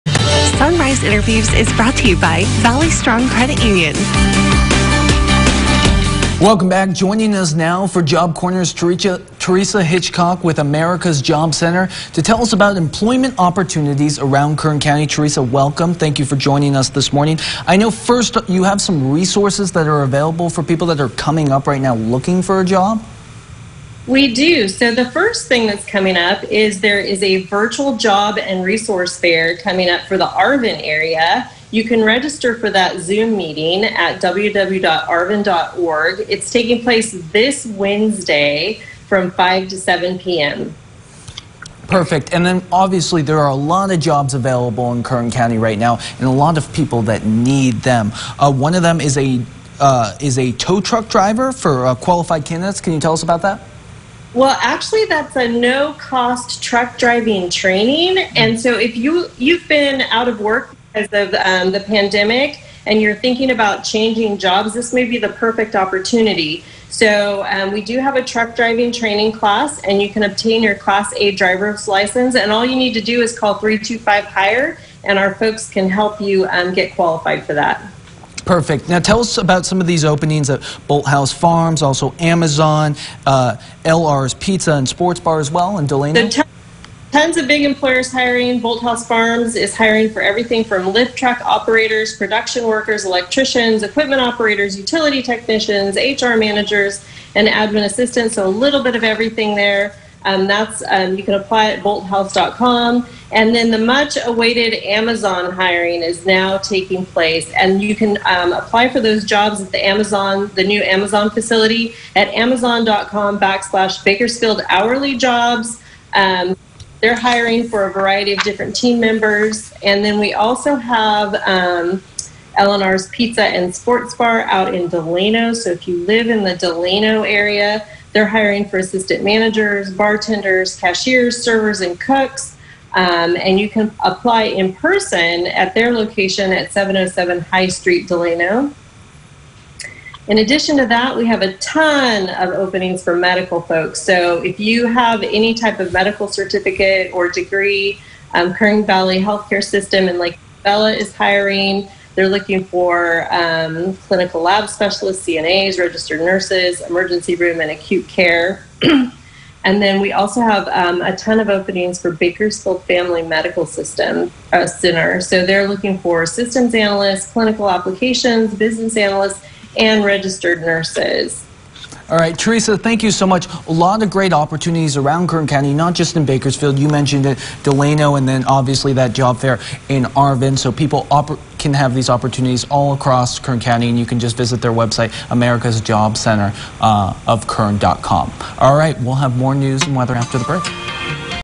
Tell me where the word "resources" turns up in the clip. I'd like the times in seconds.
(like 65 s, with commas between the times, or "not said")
19 s, 28 s.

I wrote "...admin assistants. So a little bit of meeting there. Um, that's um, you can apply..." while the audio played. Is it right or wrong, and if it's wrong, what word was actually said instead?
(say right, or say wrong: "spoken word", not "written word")
wrong: "everything", not "meeting".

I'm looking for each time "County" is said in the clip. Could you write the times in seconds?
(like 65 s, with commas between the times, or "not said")
14 s, 45 s, 175 s, 183 s.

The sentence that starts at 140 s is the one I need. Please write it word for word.
In addition to that, we have a ton of openings for medical folks.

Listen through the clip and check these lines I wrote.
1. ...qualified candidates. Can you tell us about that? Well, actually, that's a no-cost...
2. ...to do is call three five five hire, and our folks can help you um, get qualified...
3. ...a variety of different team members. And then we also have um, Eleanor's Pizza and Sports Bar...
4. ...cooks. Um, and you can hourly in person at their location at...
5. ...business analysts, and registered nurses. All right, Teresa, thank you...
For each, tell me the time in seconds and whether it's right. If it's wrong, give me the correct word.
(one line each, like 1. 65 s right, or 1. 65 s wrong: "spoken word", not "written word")
1. 51 s right
2. 72 s wrong: "two", not "five"
3. 117 s right
4. 131 s wrong: "apply", not "hourly"
5. 168 s right.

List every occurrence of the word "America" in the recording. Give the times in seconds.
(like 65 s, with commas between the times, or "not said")
10 s, 185 s.